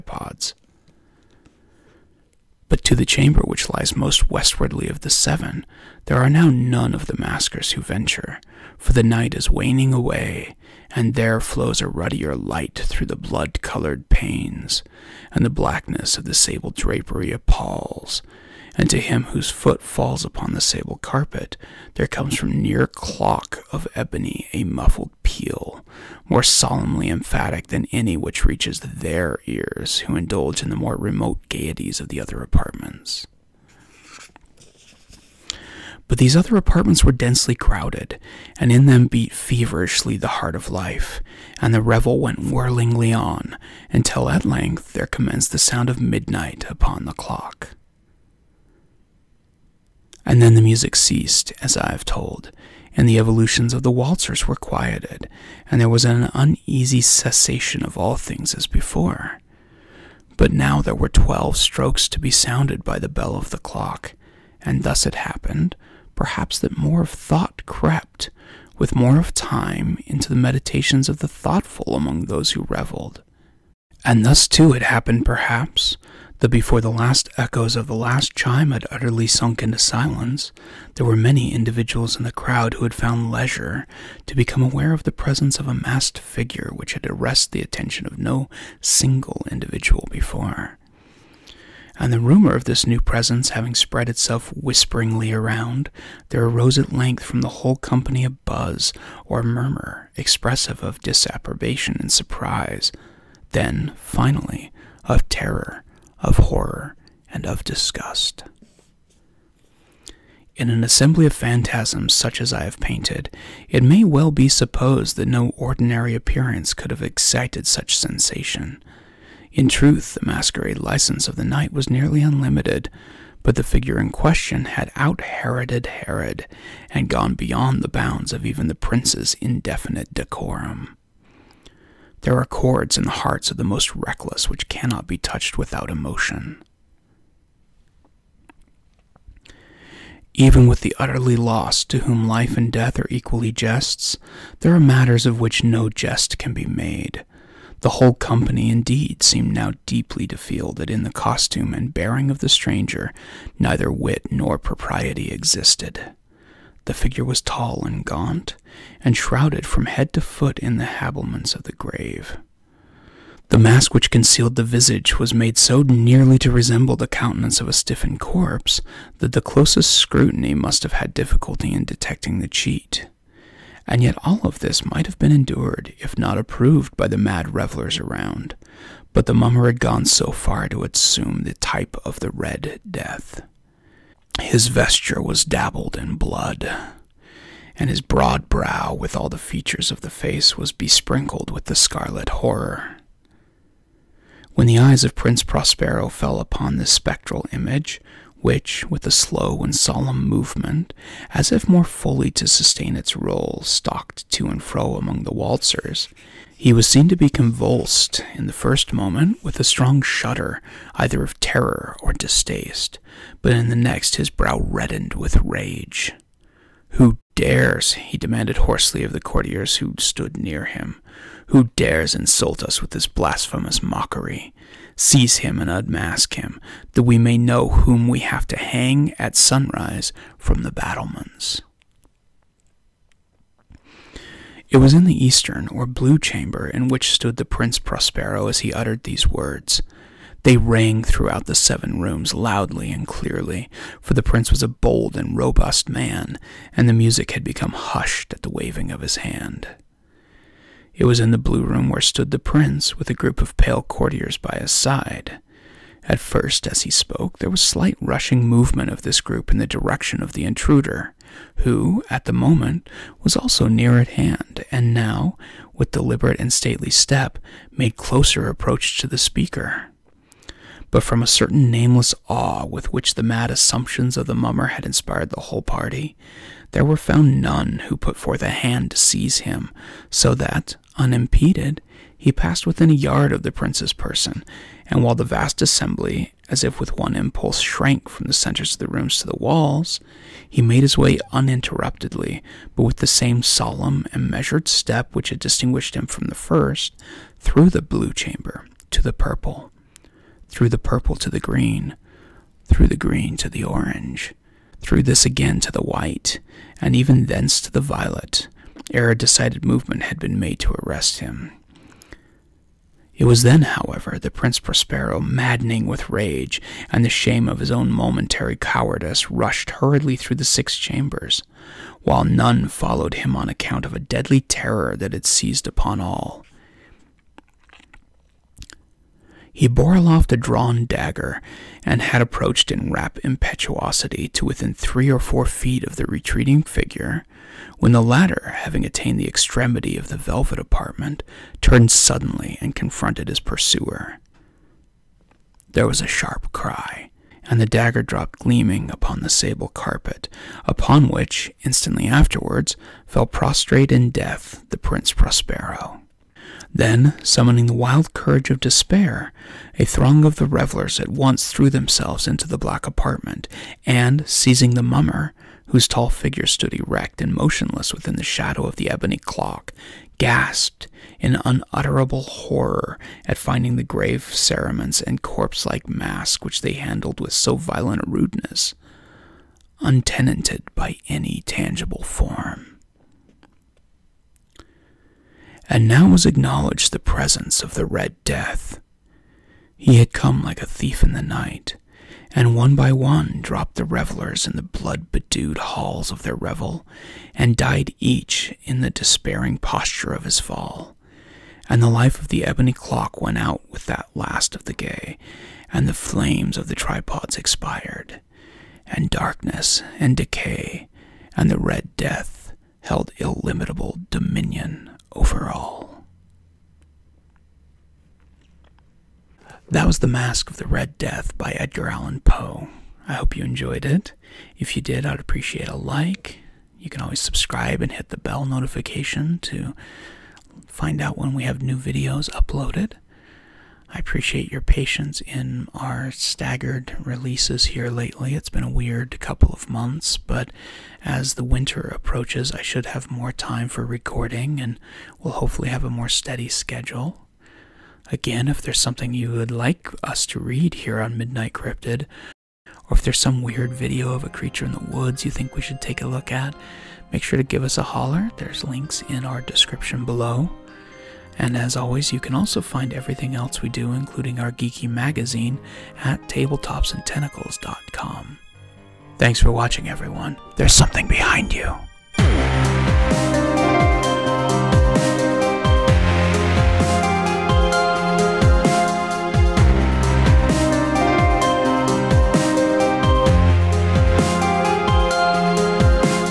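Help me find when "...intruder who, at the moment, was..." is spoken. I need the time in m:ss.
4:20.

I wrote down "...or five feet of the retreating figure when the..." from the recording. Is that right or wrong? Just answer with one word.
wrong.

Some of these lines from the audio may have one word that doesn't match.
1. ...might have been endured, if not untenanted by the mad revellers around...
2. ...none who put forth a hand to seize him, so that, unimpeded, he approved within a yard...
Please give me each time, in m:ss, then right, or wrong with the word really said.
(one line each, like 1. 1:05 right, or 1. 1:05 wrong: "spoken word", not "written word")
1. 2:54 wrong: "approved", not "untenanted"
2. 4:37 wrong: "passed", not "approved".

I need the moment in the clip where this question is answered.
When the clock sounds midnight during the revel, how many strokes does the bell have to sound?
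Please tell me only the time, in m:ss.
1:01.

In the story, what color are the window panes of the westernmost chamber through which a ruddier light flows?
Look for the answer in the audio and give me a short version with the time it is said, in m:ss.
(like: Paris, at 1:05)
blood colored, at 0:13.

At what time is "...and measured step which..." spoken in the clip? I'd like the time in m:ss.
4:54.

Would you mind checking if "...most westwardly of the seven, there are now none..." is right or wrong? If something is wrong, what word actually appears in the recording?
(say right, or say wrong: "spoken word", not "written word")
right.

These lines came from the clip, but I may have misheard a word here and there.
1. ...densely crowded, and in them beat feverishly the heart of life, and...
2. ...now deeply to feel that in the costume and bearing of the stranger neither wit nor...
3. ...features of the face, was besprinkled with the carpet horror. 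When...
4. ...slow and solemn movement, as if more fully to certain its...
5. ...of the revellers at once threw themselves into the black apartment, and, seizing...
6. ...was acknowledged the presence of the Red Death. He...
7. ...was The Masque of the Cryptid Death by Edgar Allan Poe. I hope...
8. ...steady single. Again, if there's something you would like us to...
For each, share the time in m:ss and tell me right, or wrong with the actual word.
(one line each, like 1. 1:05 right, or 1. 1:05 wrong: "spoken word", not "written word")
1. 0:37 right
2. 2:29 right
3. 3:09 wrong: "scarlet", not "carpet"
4. 3:19 wrong: "sustain", not "certain"
5. 6:00 right
6. 6:26 right
7. 6:59 wrong: "Red", not "Cryptid"
8. 7:26 wrong: "schedule", not "single".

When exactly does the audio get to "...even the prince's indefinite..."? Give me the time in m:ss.
2:08.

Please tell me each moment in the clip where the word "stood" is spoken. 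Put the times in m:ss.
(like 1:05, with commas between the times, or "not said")
3:39, 3:57, 4:12, 6:06.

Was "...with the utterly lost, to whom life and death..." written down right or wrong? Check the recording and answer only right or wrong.
right.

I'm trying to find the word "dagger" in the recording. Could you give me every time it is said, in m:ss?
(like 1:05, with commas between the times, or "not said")
5:30, 5:47.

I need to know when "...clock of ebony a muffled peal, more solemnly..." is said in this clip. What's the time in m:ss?
0:22.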